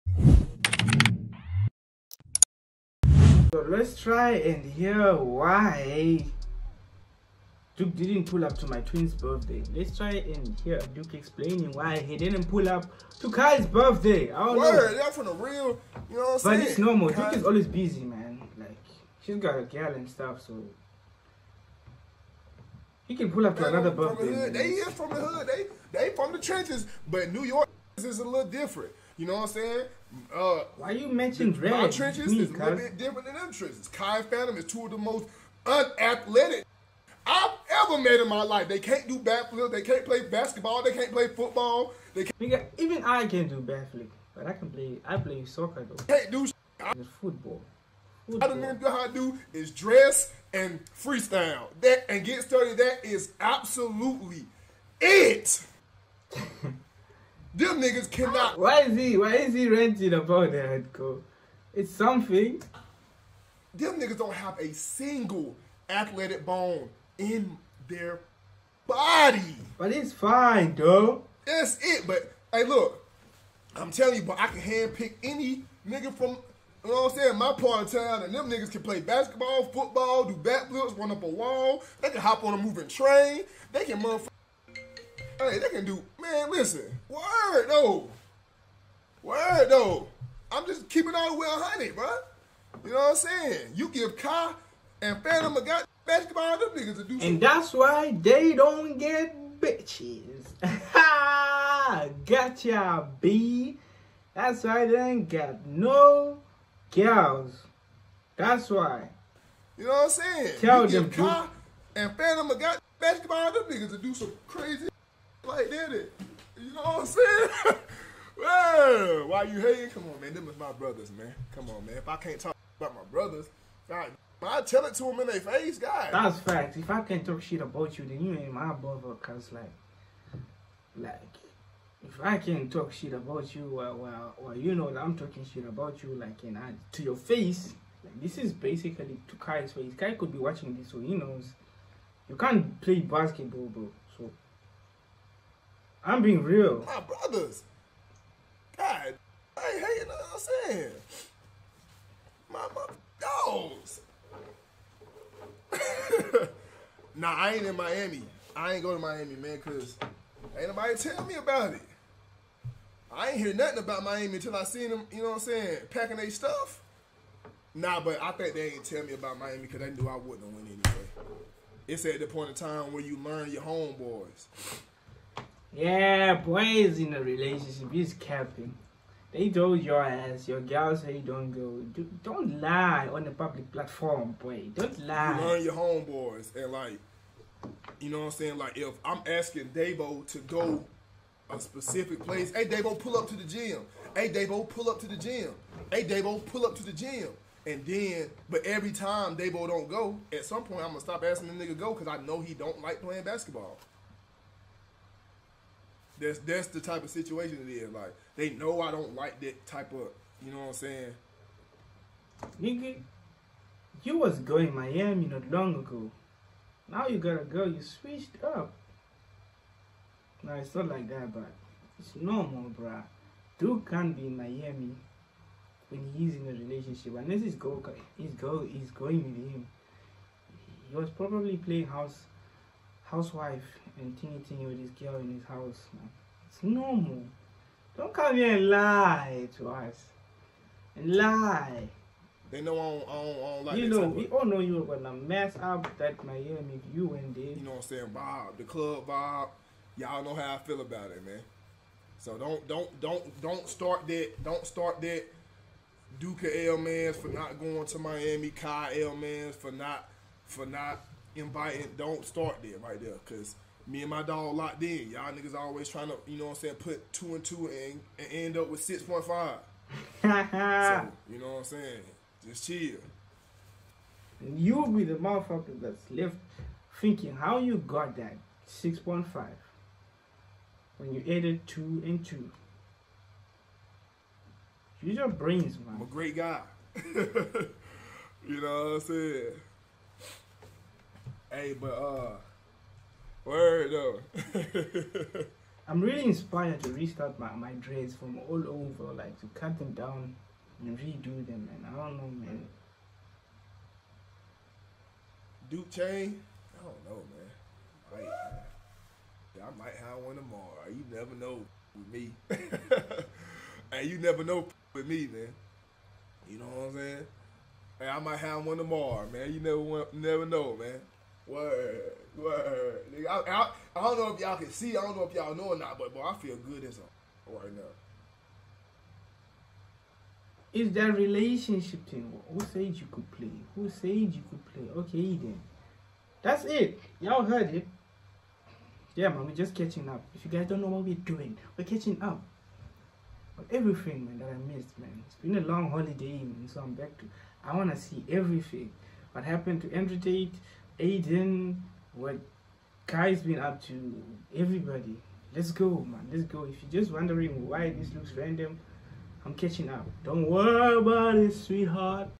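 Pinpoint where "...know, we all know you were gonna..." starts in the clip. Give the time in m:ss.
4:03.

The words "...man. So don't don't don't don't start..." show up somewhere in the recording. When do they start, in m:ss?
4:11.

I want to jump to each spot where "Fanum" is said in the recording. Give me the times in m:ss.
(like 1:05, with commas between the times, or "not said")
0:34, 1:35, 1:52.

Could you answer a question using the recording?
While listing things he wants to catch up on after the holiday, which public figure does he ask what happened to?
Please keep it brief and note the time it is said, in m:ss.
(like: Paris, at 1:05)
Andrew Tate, at 5:49.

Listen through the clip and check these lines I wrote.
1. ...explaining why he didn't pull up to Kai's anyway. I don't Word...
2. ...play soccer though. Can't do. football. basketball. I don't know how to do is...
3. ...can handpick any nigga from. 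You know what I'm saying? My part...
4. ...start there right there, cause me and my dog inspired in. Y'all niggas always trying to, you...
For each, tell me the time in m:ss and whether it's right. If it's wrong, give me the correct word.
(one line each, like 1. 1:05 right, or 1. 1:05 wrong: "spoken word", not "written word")
1. 0:11 wrong: "birthday", not "anyway"
2. 0:45 wrong: "football", not "basketball"
3. 1:14 right
4. 4:22 wrong: "locked", not "inspired".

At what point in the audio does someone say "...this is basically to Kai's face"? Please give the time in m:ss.
2:18.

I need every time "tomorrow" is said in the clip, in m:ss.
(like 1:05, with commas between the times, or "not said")
5:10, 5:18.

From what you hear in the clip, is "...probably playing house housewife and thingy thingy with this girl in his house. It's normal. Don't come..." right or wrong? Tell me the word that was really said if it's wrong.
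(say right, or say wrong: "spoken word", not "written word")
right.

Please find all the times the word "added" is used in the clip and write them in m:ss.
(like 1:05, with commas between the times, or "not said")
4:41.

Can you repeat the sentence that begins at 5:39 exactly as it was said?
Yeah, man, we're just catching up.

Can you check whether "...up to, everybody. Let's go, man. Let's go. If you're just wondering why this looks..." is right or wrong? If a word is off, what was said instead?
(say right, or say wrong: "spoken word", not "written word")
right.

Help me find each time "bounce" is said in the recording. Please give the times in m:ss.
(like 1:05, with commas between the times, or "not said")
not said.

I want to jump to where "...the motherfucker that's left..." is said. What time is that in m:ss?
4:35.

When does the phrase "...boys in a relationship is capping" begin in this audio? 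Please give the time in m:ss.
2:56.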